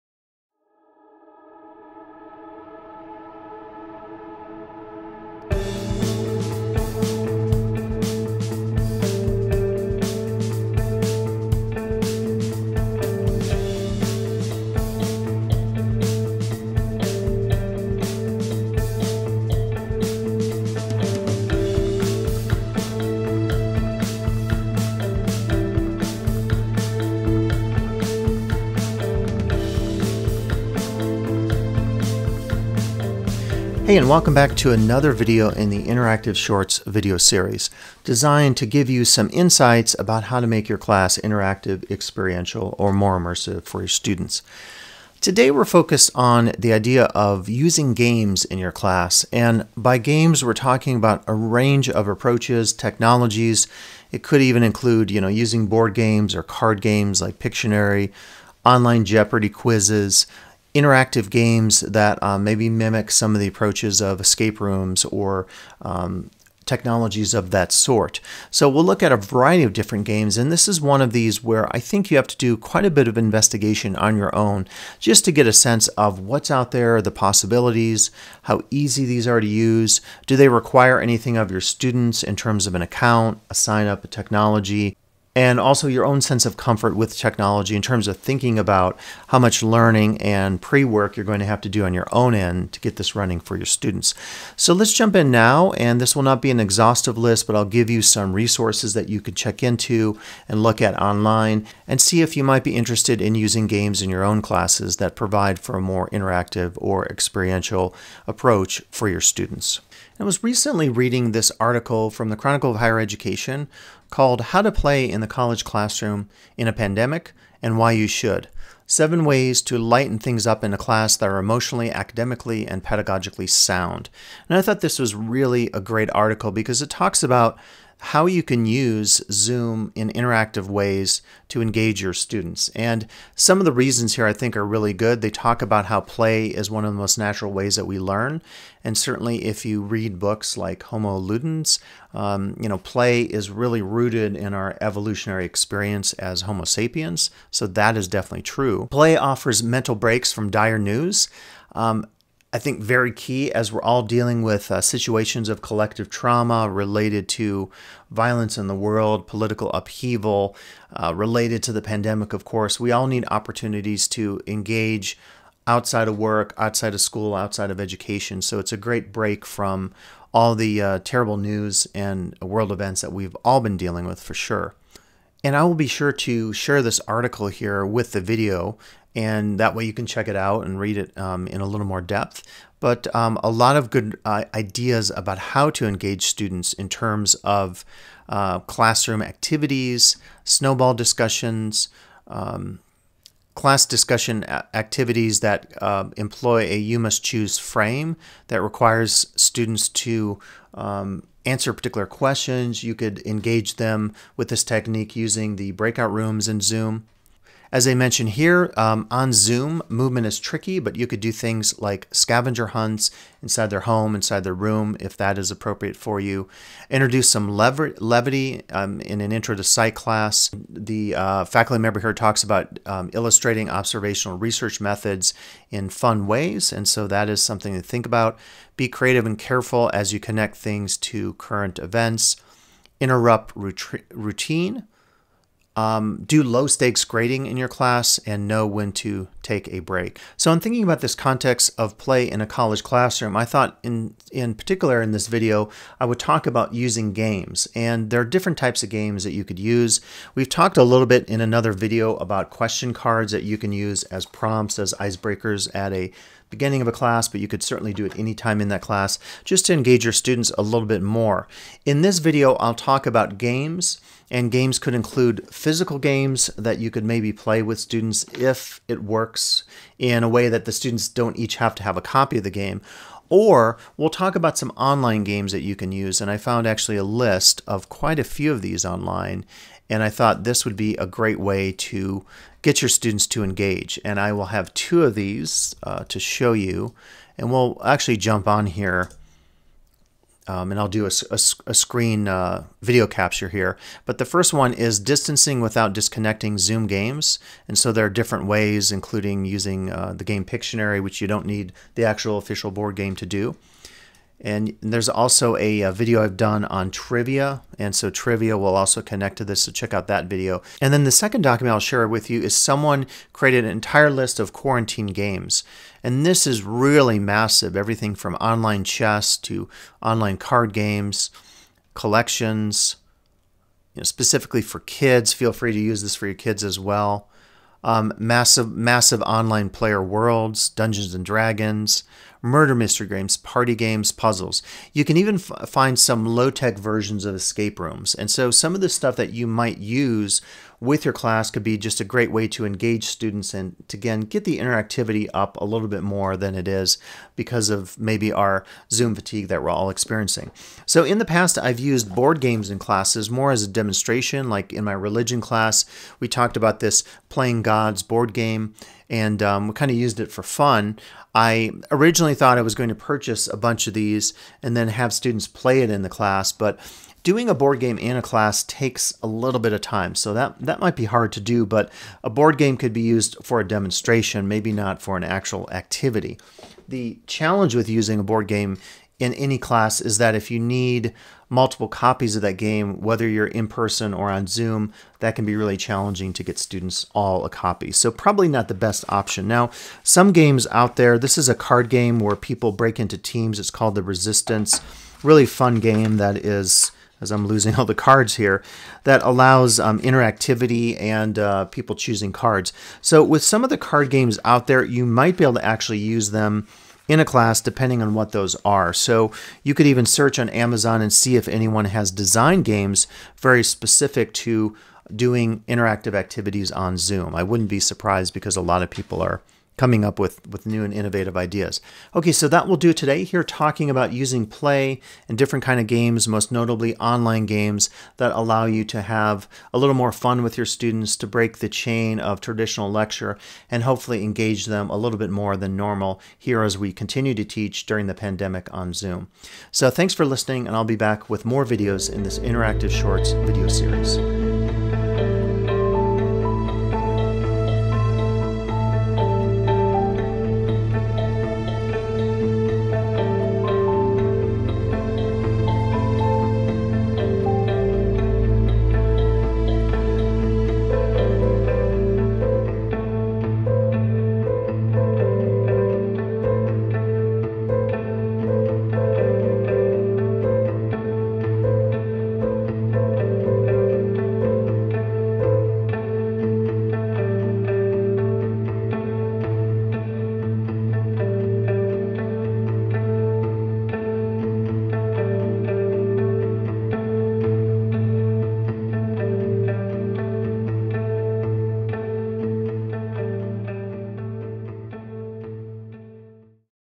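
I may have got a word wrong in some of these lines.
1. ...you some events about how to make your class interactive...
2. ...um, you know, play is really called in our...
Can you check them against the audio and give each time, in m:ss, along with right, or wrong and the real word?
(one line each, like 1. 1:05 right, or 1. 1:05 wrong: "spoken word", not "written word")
1. 0:38 wrong: "insights", not "events"
2. 2:22 wrong: "rooted", not "called".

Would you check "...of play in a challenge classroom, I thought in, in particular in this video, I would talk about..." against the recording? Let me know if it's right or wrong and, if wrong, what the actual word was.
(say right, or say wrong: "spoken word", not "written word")
wrong: "college", not "challenge".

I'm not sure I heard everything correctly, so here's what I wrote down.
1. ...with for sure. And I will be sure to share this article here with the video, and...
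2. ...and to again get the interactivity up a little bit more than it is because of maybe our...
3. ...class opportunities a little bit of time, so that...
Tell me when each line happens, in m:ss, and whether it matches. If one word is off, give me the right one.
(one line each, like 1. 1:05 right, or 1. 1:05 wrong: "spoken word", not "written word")
1. 2:54 right
2. 5:43 right
3. 6:08 wrong: "takes", not "opportunities".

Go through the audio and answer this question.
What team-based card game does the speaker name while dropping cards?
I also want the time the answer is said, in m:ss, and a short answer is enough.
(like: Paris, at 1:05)
The Resistance, at 6:33.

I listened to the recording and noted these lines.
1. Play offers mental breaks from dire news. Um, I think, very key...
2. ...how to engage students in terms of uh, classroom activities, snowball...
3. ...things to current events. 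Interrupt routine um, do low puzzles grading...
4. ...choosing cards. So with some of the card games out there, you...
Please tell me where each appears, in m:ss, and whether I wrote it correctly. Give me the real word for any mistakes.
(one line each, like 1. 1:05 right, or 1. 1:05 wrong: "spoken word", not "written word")
1. 2:28 right
2. 3:05 right
3. 3:50 wrong: "stakes", not "puzzles"
4. 6:41 right.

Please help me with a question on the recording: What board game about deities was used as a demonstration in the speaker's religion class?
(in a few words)
Playing Gods.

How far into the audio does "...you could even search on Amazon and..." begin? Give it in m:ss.
6:49.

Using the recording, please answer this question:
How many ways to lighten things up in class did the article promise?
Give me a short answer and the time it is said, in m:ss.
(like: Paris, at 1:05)
7, at 1:58.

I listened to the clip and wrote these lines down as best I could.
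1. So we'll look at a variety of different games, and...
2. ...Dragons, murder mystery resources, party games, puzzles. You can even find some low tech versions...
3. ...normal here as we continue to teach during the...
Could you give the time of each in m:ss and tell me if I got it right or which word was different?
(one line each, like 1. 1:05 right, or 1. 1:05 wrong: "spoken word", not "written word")
1. 1:08 right
2. 5:31 wrong: "games", not "resources"
3. 7:15 right.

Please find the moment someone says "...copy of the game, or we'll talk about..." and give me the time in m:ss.
4:32.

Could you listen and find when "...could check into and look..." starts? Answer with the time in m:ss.
1:39.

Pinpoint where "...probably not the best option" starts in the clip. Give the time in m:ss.
6:28.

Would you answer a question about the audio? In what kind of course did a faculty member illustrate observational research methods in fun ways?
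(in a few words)
Intro to psych.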